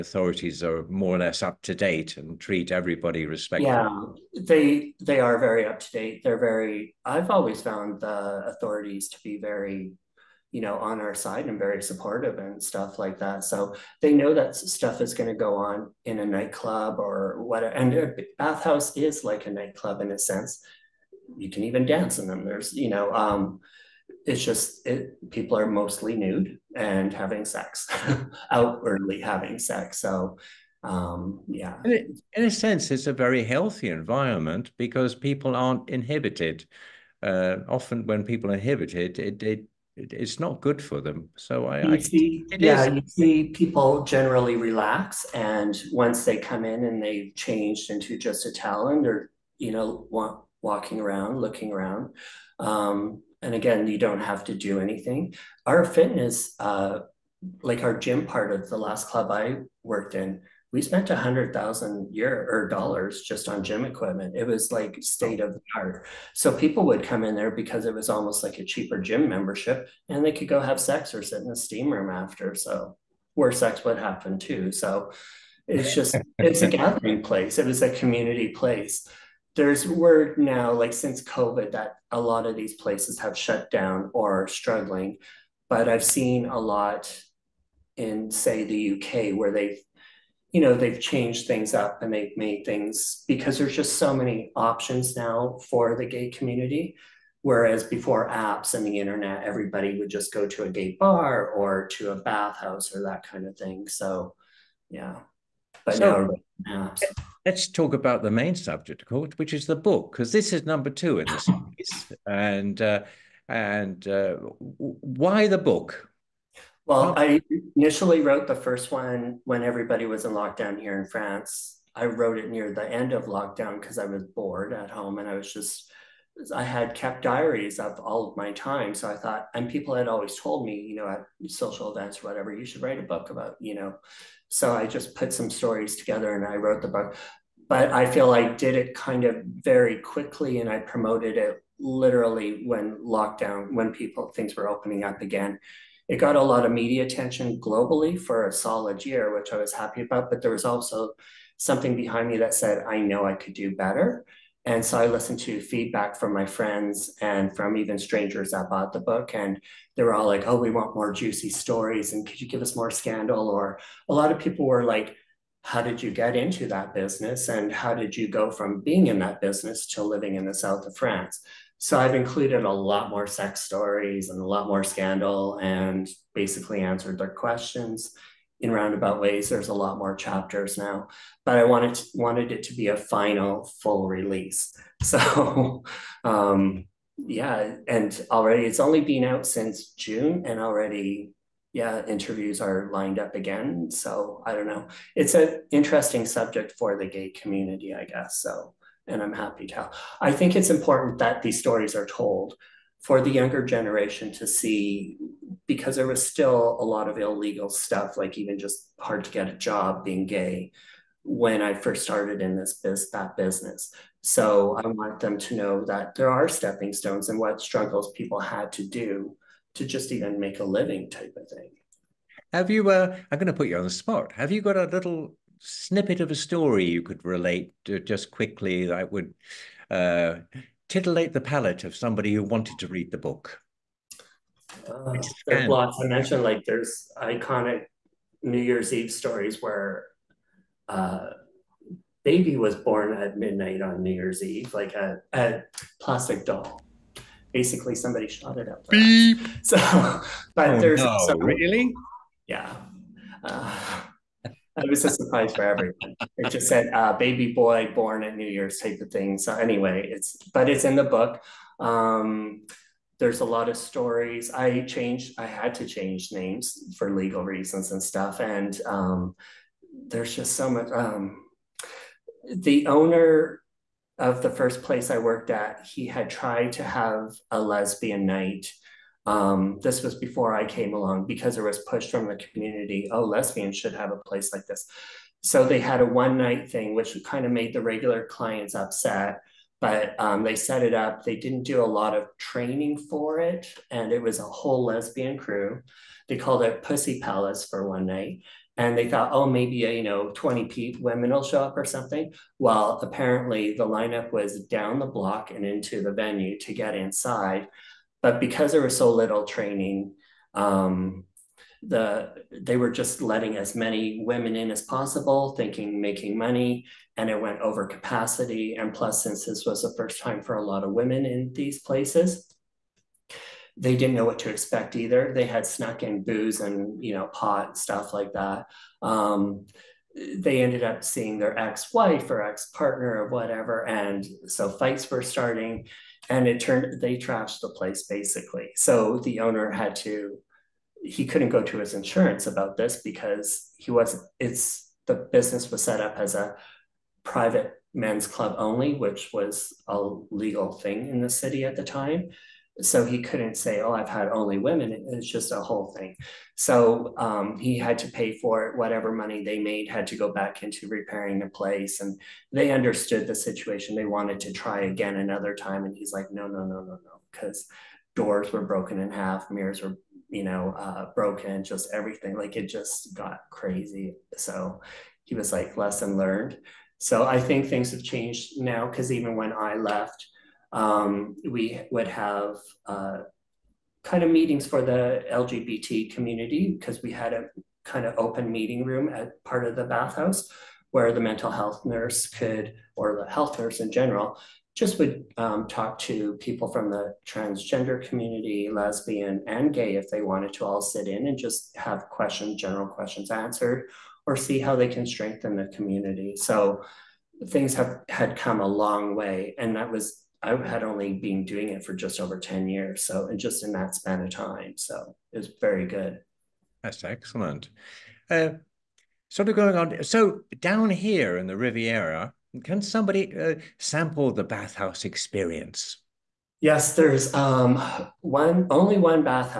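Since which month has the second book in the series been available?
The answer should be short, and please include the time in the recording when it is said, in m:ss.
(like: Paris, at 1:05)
June, at 3:09.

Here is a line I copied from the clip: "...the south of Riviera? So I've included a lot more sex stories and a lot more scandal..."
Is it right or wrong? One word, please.
wrong.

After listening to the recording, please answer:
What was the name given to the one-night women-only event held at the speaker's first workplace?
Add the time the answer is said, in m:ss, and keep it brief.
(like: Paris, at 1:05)
Pussy Palace, at 4:56.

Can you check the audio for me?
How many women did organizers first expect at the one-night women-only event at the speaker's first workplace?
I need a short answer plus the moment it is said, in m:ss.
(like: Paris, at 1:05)
20, at 5:00.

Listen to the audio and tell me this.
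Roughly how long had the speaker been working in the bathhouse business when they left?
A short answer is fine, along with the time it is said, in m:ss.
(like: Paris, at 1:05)
Just over 10 years, at 6:51.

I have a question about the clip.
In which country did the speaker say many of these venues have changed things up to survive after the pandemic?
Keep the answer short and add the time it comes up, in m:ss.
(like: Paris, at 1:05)
UK, at 1:28.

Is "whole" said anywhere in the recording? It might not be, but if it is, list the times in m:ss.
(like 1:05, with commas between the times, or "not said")
4:54, 5:55.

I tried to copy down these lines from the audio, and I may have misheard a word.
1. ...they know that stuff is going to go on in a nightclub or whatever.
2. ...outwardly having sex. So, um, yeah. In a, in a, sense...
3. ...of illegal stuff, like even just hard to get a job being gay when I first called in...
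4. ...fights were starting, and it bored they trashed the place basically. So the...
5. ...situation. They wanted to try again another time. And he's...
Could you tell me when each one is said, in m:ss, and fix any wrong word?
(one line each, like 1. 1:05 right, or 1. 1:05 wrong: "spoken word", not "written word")
1. 0:14 right
2. 0:28 right
3. 3:27 wrong: "started", not "called"
4. 5:34 wrong: "turned", not "bored"
5. 6:03 right.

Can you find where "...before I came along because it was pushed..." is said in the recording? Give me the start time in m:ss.
4:40.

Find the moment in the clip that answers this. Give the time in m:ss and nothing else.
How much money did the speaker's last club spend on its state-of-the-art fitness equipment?
1:01.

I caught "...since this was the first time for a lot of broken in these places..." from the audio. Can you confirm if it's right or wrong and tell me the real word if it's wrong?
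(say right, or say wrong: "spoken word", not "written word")
wrong: "women", not "broken".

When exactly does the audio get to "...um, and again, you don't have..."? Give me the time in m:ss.
0:52.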